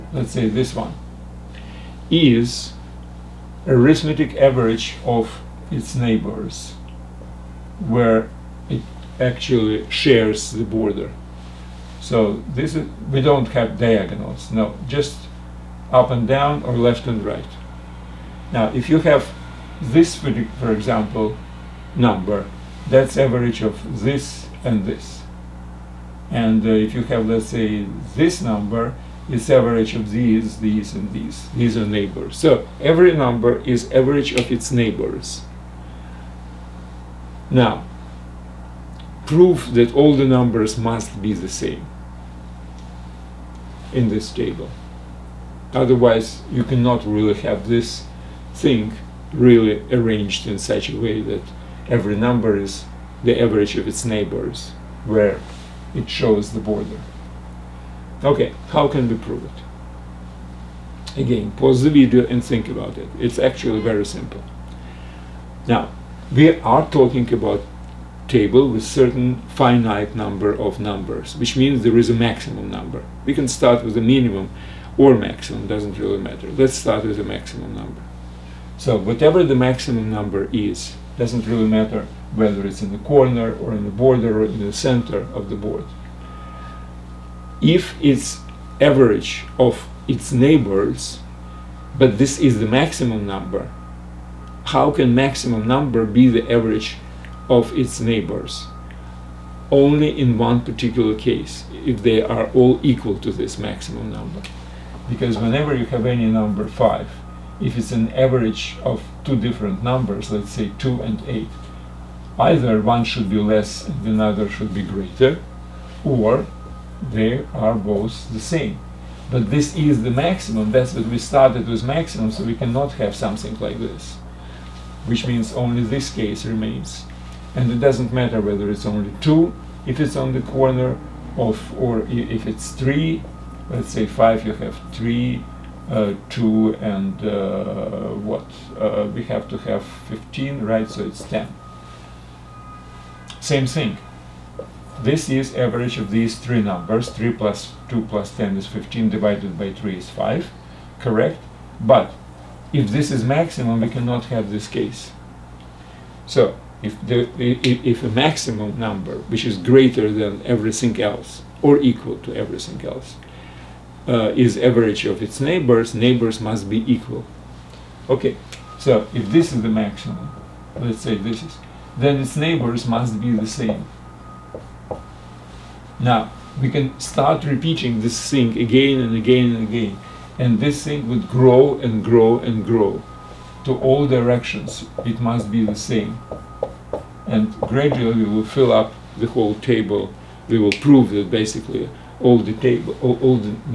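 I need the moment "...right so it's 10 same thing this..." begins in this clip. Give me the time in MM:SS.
02:20.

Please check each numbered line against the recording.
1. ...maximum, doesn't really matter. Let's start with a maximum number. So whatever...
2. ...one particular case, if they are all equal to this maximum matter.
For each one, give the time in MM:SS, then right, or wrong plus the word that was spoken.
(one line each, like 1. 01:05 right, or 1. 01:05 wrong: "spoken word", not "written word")
1. 01:15 right
2. 01:40 wrong: "number", not "matter".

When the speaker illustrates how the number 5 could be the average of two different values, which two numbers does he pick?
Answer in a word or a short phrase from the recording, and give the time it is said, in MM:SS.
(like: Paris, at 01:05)
2 and 8, at 01:50.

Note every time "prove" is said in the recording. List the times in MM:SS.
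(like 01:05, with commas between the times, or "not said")
00:39, 00:59, 03:10.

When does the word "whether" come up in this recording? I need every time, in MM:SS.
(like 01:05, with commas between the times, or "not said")
01:22, 02:08.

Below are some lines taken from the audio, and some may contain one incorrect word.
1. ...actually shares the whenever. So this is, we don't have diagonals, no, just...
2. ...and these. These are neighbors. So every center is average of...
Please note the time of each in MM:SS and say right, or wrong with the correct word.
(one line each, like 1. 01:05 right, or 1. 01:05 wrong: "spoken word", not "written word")
1. 00:09 wrong: "border", not "whenever"
2. 00:30 wrong: "number", not "center".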